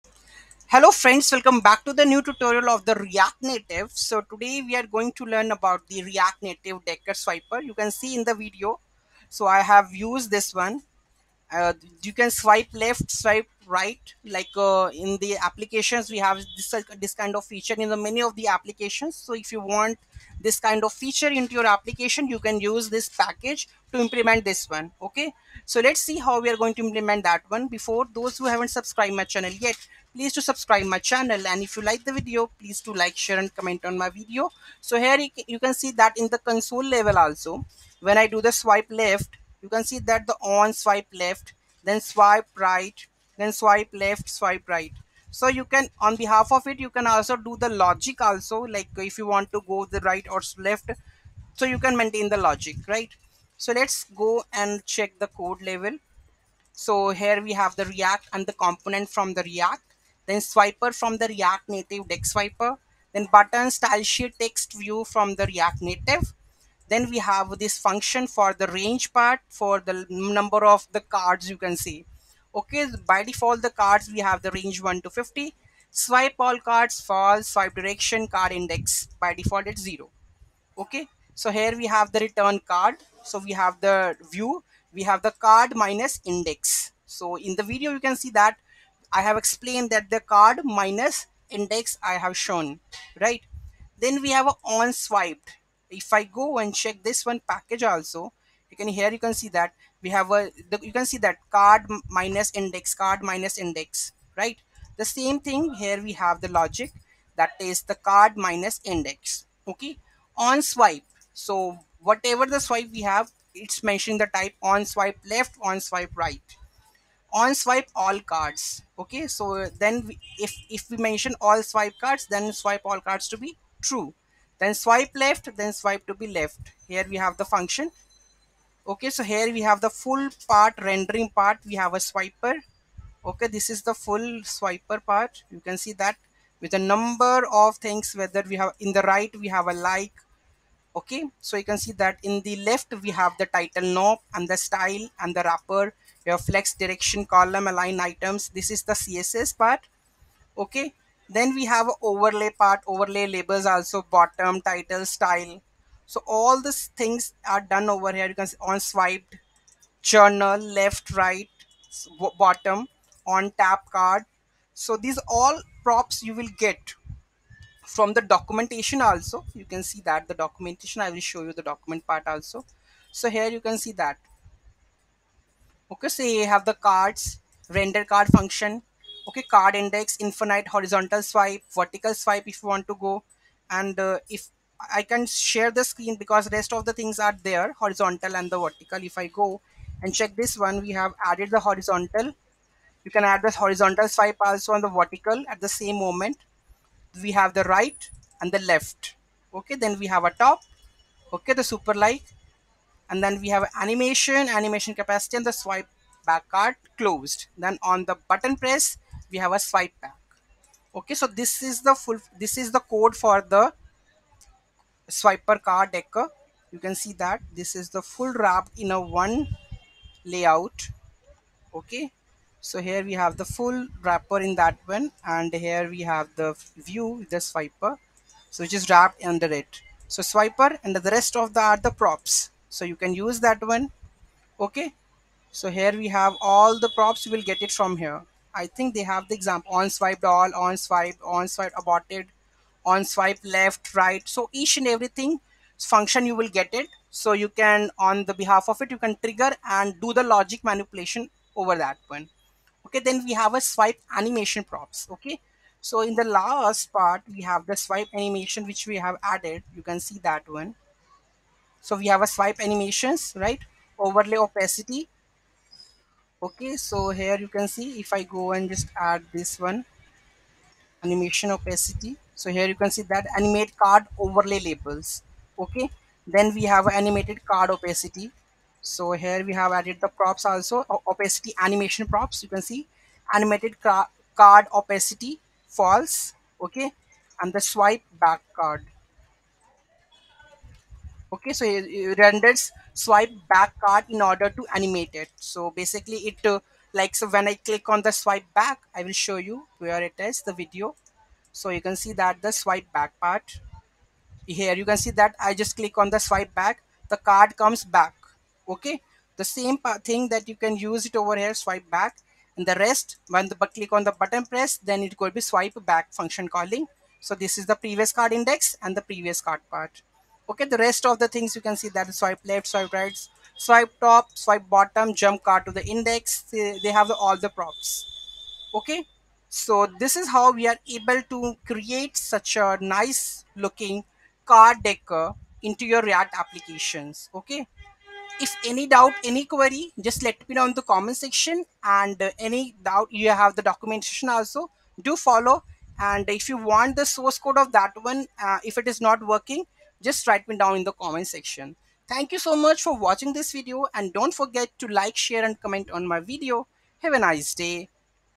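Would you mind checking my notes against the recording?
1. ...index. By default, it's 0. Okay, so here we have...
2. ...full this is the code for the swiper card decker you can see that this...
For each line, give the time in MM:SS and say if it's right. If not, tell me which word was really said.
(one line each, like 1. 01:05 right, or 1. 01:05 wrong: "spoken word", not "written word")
1. 01:18 right
2. 03:31 right.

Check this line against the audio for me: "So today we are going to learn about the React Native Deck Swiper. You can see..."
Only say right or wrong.
right.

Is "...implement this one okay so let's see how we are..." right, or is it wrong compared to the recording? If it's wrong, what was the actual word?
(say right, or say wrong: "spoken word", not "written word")
right.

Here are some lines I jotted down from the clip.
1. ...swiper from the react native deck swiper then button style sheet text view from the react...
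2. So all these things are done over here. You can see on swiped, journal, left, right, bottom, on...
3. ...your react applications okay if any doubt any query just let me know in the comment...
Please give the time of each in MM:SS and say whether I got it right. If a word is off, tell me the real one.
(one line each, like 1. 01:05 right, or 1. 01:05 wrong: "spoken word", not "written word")
1. 01:00 right
2. 02:36 right
3. 05:35 right.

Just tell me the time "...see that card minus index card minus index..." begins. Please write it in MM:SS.
01:41.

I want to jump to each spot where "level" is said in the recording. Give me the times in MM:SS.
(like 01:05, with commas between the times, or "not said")
00:36, 00:55.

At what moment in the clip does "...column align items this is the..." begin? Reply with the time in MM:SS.
02:27.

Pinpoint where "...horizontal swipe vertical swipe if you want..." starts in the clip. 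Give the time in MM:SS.
03:00.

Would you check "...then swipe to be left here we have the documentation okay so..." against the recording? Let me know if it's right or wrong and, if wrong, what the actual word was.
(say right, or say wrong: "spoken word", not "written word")
wrong: "function", not "documentation".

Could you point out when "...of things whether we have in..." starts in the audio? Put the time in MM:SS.
02:17.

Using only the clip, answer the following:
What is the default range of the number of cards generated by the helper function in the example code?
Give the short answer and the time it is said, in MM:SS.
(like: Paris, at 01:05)
1 to 50, at 01:14.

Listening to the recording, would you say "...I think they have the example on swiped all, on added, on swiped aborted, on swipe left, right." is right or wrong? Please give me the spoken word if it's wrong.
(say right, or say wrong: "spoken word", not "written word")
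wrong: "swiped", not "added".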